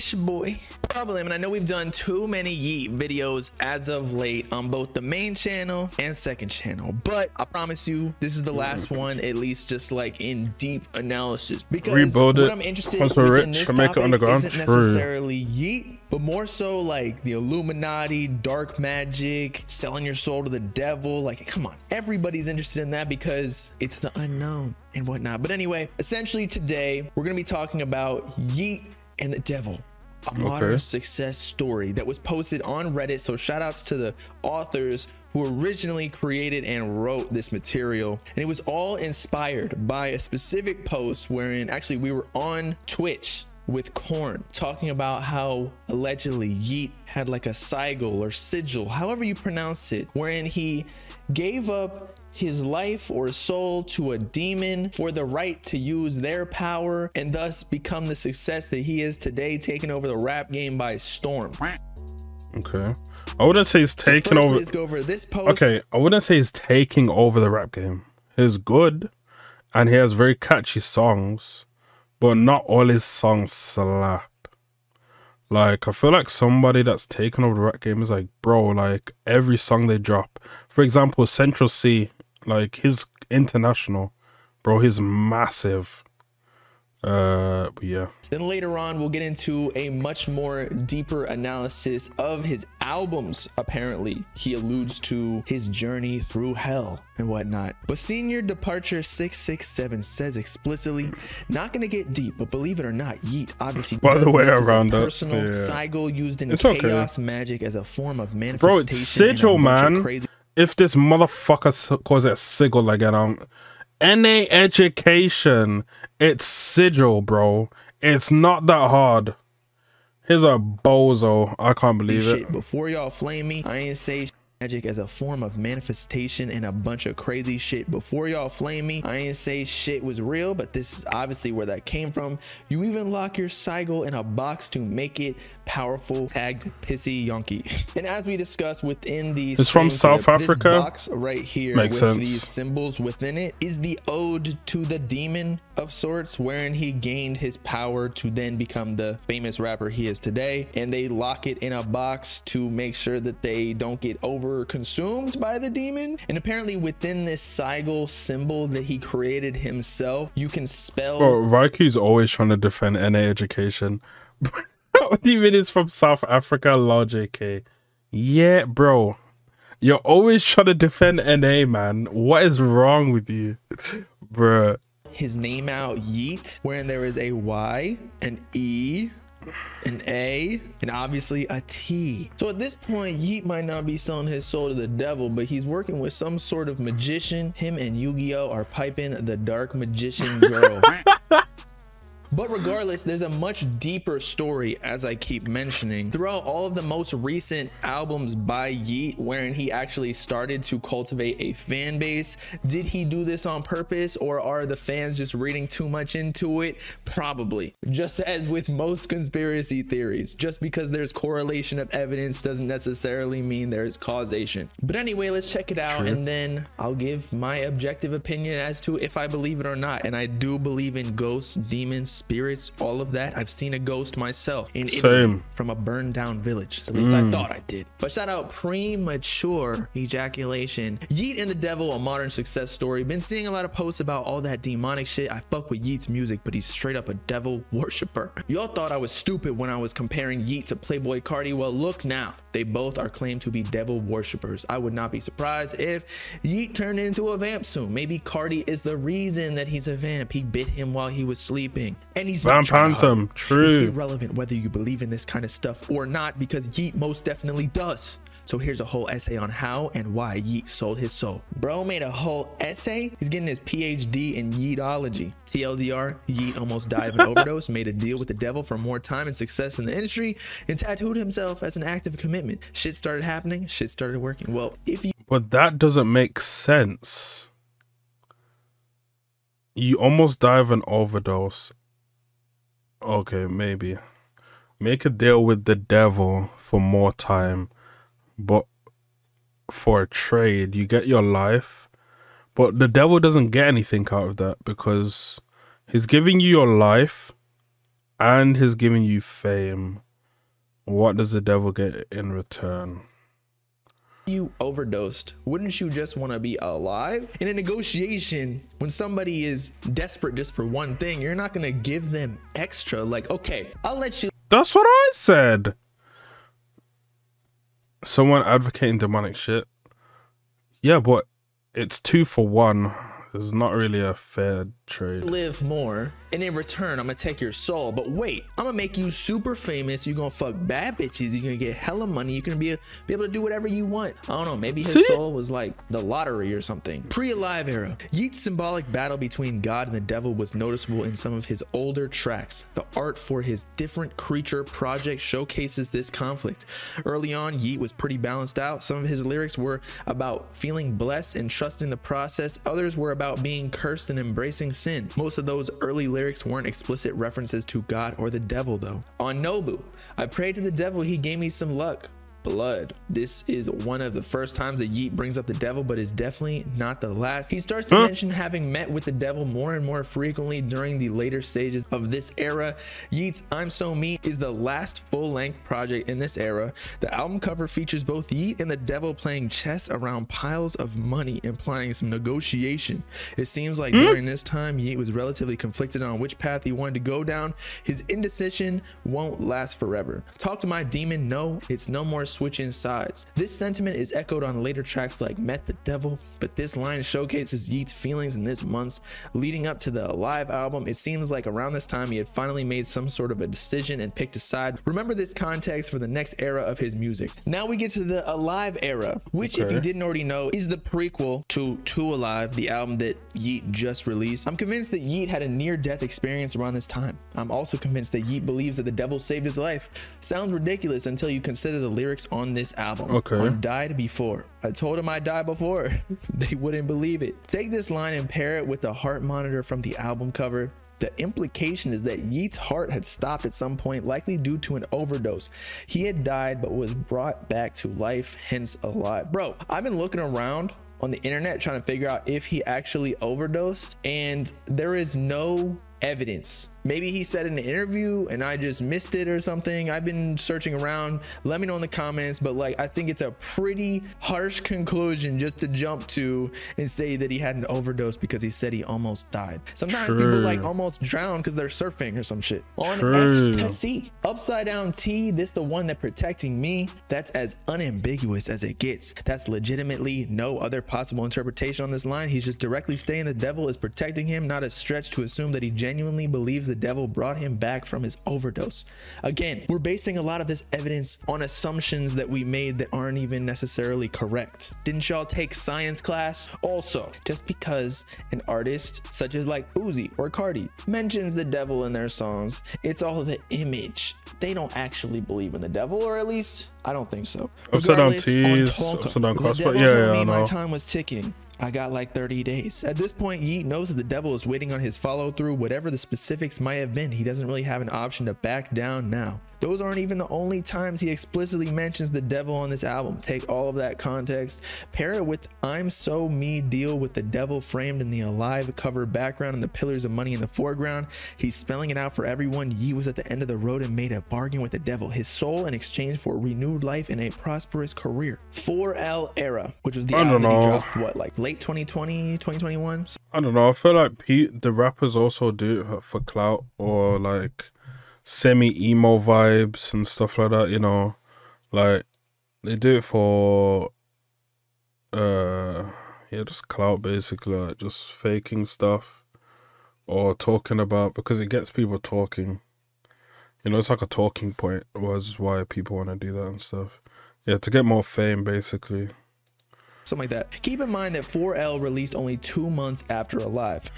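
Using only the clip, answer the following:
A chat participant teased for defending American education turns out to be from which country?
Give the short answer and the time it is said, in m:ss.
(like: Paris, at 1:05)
South Africa, at 2:45.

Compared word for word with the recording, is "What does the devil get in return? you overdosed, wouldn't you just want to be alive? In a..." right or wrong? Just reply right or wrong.
right.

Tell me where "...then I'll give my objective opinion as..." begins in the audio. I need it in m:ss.
3:36.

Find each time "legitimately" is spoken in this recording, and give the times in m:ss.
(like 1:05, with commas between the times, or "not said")
7:49.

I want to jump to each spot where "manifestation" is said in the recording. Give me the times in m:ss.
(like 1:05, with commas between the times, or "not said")
1:48, 2:05.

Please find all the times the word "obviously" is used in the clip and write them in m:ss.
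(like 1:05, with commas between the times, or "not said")
1:43, 2:11, 3:00.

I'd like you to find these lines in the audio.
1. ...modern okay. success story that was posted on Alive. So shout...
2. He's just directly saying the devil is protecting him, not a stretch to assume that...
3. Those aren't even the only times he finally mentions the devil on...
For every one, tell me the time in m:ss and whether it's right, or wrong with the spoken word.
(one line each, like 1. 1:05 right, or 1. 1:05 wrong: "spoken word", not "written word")
1. 0:30 wrong: "Reddit", not "Alive"
2. 7:52 right
3. 8:29 wrong: "explicitly", not "finally".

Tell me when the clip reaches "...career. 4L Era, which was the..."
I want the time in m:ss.
8:47.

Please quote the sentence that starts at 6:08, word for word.
mention having met with the devil more and more frequently during the later stages of this era.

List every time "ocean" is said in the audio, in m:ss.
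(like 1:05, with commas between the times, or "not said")
not said.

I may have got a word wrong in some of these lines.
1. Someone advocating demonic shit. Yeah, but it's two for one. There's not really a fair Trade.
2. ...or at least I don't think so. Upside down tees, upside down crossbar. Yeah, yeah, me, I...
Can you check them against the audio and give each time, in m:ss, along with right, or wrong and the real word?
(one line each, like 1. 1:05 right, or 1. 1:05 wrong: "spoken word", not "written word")
1. 5:18 right
2. 8:16 right.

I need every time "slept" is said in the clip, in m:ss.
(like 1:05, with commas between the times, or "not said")
not said.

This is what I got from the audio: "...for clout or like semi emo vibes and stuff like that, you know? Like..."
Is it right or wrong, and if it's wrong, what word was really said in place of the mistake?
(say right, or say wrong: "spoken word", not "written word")
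right.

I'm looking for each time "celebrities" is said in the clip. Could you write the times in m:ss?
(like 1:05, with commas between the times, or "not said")
not said.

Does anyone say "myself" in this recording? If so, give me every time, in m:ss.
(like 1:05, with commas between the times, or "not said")
3:44.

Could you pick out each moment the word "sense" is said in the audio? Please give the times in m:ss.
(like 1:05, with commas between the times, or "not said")
2:22, 4:36.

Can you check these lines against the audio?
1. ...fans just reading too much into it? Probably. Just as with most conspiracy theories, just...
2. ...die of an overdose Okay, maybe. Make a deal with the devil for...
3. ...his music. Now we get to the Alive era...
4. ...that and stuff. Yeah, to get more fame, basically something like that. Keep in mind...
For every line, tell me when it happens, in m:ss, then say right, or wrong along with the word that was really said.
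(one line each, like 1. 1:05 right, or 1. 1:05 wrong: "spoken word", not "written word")
1. 3:24 right
2. 4:40 right
3. 6:46 right
4. 9:16 right.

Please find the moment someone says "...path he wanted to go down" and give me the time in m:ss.
6:26.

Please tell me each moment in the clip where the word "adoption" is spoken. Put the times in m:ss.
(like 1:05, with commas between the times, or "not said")
not said.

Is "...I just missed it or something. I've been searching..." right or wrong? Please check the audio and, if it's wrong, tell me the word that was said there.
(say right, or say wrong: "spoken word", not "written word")
right.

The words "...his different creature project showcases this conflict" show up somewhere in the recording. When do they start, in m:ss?
5:43.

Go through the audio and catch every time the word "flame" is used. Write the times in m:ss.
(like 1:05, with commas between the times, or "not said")
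2:03, 2:08.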